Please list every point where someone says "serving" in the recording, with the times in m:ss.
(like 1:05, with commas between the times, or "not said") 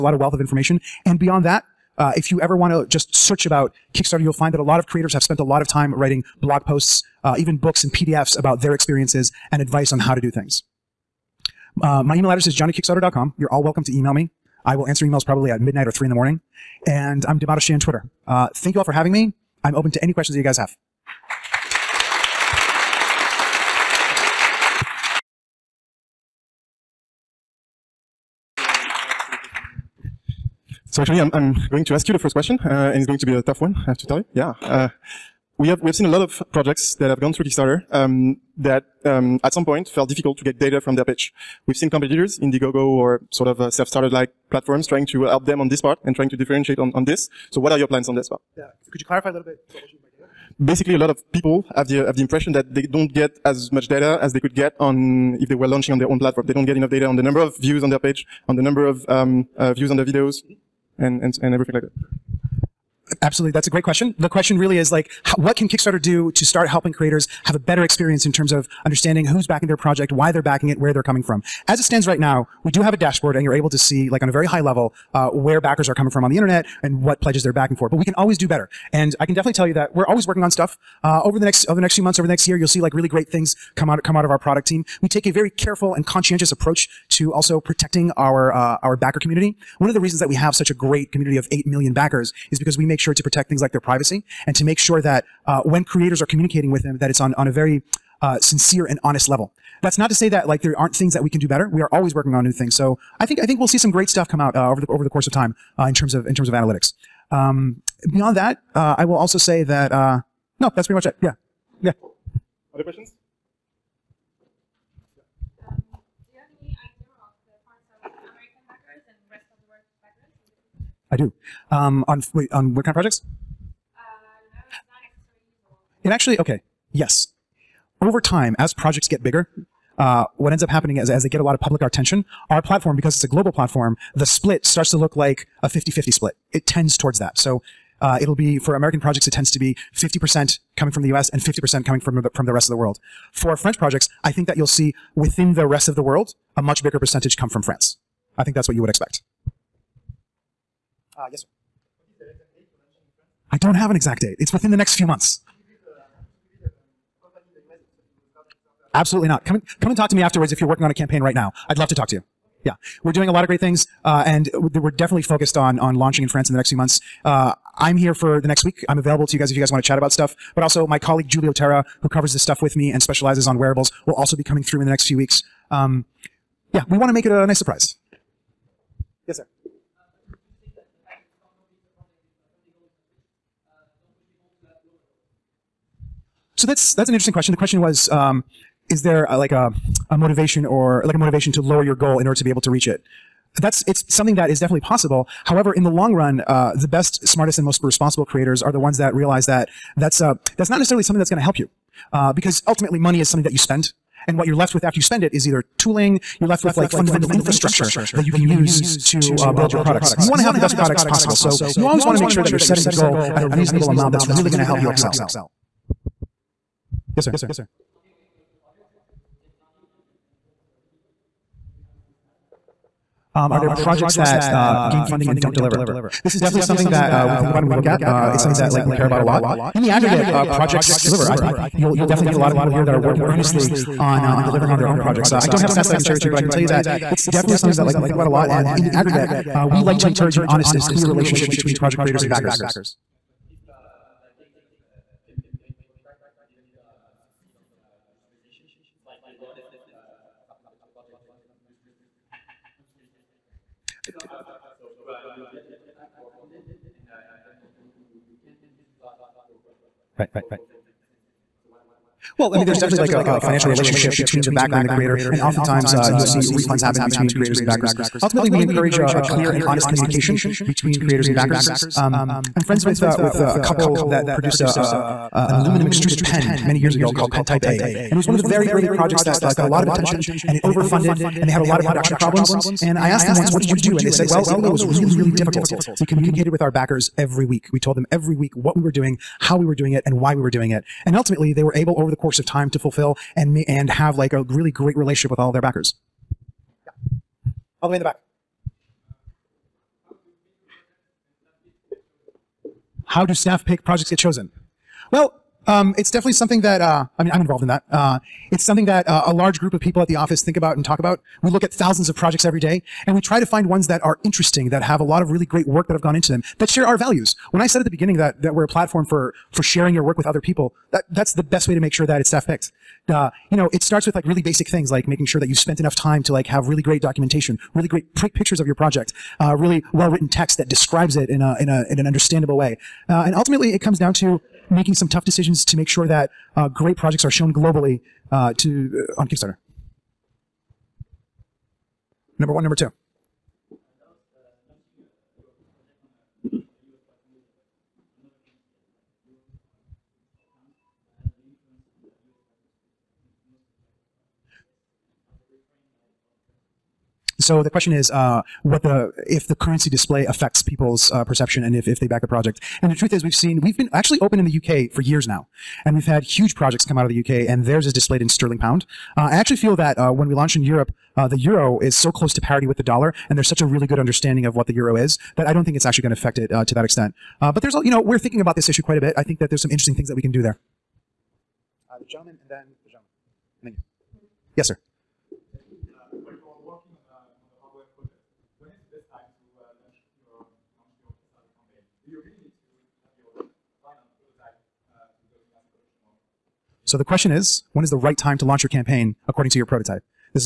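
not said.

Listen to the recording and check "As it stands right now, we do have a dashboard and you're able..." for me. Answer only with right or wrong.
right.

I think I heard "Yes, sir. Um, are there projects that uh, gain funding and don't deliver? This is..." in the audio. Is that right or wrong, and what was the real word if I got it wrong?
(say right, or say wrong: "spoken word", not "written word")
right.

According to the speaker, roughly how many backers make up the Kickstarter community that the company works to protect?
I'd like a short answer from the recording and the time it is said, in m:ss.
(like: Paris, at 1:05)
8 million, at 1:31.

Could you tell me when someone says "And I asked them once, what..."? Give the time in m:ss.
4:42.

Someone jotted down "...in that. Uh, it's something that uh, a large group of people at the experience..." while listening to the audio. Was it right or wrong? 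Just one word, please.
wrong.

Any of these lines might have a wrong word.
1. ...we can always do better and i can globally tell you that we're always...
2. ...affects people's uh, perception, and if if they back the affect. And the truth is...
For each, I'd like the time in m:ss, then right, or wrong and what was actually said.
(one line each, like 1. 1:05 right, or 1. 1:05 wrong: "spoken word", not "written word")
1. 1:17 wrong: "definitely", not "globally"
2. 6:00 wrong: "project", not "affect".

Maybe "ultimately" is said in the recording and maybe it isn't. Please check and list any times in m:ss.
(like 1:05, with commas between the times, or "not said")
3:22, 4:28, 4:51, 5:33.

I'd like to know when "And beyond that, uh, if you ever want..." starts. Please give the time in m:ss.
0:01.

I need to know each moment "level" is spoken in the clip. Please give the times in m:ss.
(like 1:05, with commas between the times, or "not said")
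1:14, 1:39.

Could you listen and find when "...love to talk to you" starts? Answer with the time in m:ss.
2:41.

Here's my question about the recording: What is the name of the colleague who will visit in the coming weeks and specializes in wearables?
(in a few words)
Julio Terra.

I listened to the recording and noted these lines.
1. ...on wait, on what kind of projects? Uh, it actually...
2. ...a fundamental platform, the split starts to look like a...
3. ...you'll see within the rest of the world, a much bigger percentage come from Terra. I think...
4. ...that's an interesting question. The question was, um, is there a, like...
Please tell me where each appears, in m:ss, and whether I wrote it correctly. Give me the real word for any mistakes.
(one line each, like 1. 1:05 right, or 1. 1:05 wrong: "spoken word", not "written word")
1. 2:02 right
2. 2:13 wrong: "global", not "fundamental"
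3. 2:24 wrong: "France", not "Terra"
4. 3:06 right.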